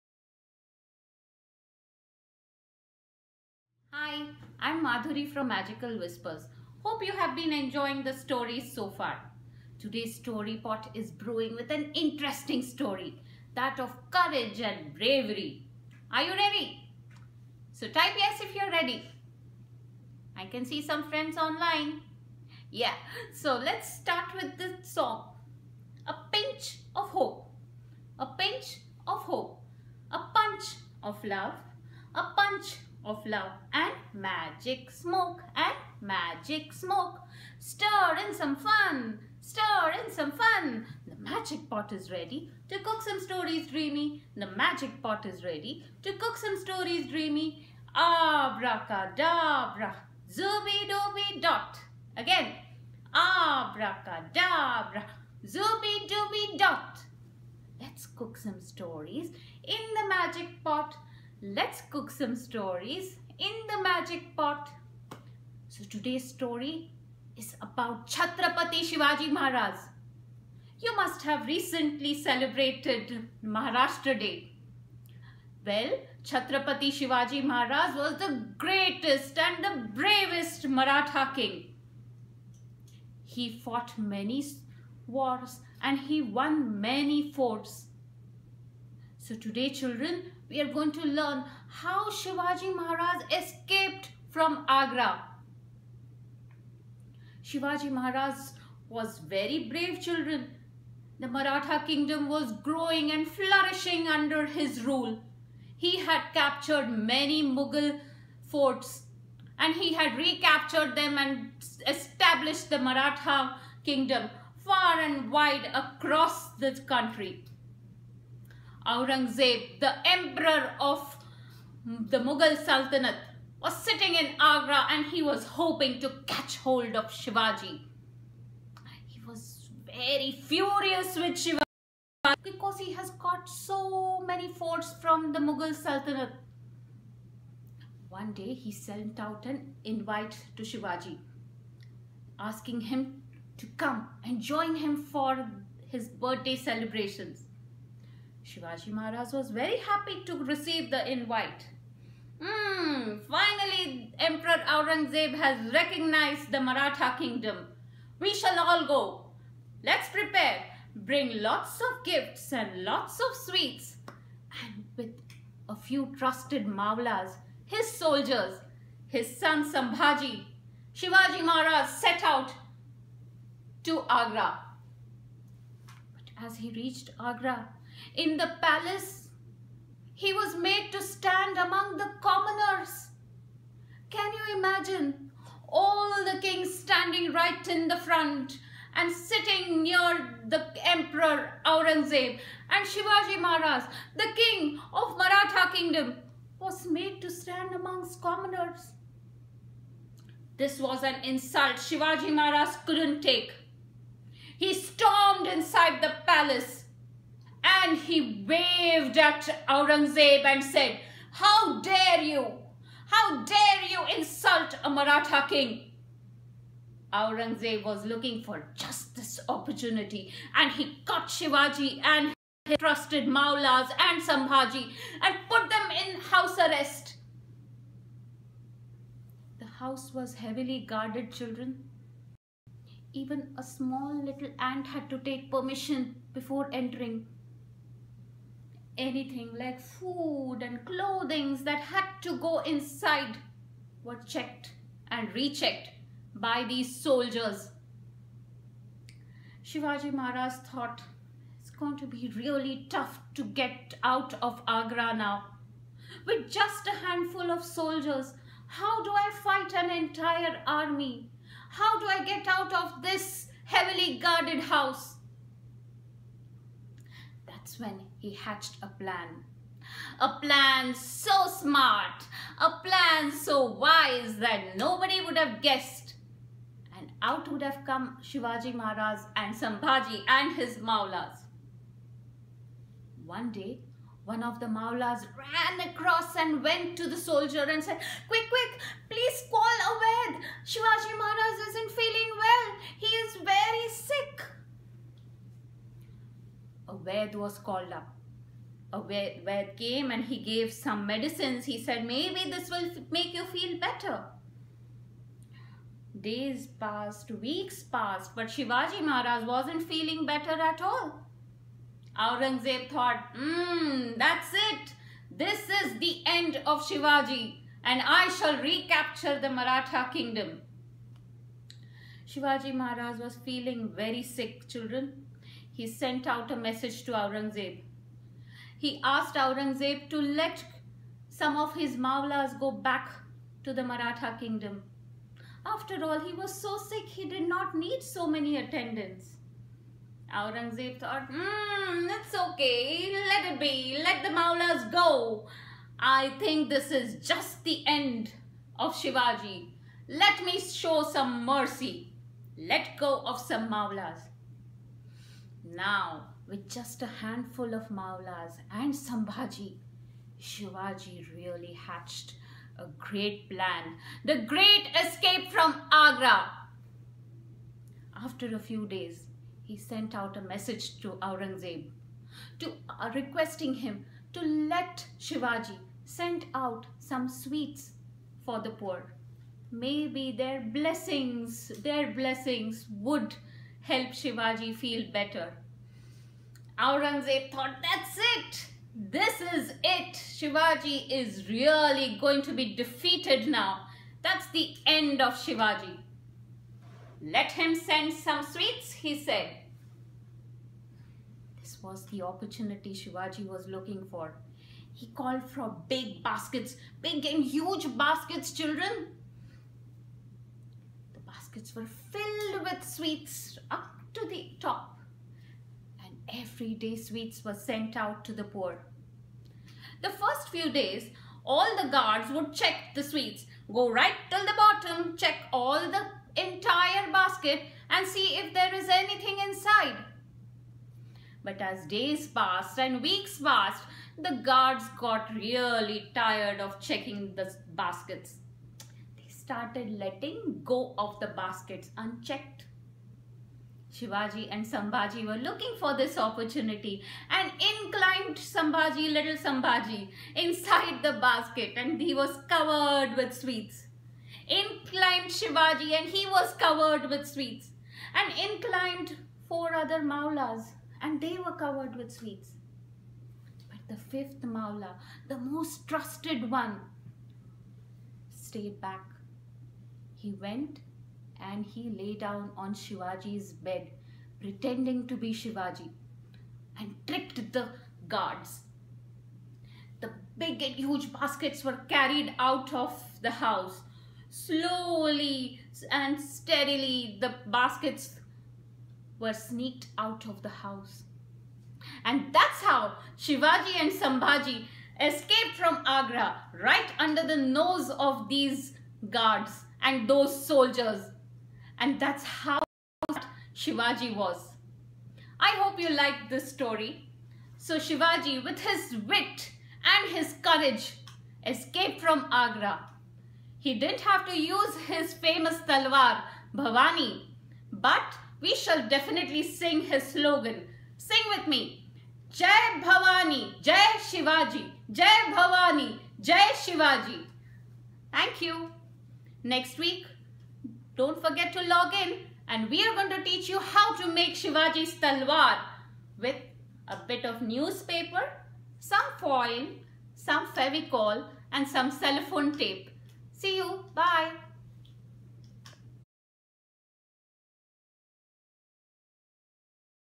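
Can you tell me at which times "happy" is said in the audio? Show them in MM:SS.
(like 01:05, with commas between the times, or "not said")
02:29.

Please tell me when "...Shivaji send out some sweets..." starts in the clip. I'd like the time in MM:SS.
06:15.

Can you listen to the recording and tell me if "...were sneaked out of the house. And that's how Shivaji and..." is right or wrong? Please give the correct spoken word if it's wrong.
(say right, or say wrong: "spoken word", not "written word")
right.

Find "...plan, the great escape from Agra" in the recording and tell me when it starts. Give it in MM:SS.
06:03.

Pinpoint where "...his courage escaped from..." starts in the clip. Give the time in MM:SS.
08:30.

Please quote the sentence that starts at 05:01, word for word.
He said, maybe this will make you feel better.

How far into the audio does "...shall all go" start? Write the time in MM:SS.
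02:38.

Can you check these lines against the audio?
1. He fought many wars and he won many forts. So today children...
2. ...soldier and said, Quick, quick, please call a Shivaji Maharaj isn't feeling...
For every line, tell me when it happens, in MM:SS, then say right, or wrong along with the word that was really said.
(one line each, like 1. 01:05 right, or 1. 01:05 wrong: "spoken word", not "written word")
1. 01:23 right
2. 04:47 right.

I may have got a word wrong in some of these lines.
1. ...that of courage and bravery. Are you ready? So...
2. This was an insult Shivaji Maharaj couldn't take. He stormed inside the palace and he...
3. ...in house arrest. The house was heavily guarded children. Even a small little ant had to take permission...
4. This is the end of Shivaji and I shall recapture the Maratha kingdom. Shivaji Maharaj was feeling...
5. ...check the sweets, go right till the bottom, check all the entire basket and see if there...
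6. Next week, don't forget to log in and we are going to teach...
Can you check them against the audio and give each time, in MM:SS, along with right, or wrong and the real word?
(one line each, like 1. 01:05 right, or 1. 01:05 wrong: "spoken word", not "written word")
1. 00:13 right
2. 03:20 right
3. 03:46 right
4. 05:15 right
5. 07:02 right
6. 08:49 right.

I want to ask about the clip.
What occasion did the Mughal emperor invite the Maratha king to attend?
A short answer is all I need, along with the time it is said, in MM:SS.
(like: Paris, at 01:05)
His birthday celebrations, at 02:26.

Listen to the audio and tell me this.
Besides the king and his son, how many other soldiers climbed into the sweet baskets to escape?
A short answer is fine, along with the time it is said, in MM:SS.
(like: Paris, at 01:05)
4, at 07:39.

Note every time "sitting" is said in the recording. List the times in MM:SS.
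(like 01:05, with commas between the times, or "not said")
02:03, 03:09.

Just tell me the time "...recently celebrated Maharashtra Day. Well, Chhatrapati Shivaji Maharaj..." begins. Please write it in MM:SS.
01:11.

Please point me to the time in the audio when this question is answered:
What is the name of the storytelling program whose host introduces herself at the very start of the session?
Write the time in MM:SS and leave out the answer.
00:05.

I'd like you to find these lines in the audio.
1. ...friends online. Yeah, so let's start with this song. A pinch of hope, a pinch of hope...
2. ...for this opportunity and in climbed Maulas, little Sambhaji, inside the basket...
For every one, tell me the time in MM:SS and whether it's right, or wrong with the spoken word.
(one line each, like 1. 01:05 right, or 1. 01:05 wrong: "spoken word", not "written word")
1. 00:21 right
2. 07:25 wrong: "Sambhaji", not "Maulas".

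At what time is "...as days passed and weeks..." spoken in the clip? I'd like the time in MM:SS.
07:11.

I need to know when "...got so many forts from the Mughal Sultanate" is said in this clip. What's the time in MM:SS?
02:13.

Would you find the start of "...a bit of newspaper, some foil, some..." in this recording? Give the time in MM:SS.
08:56.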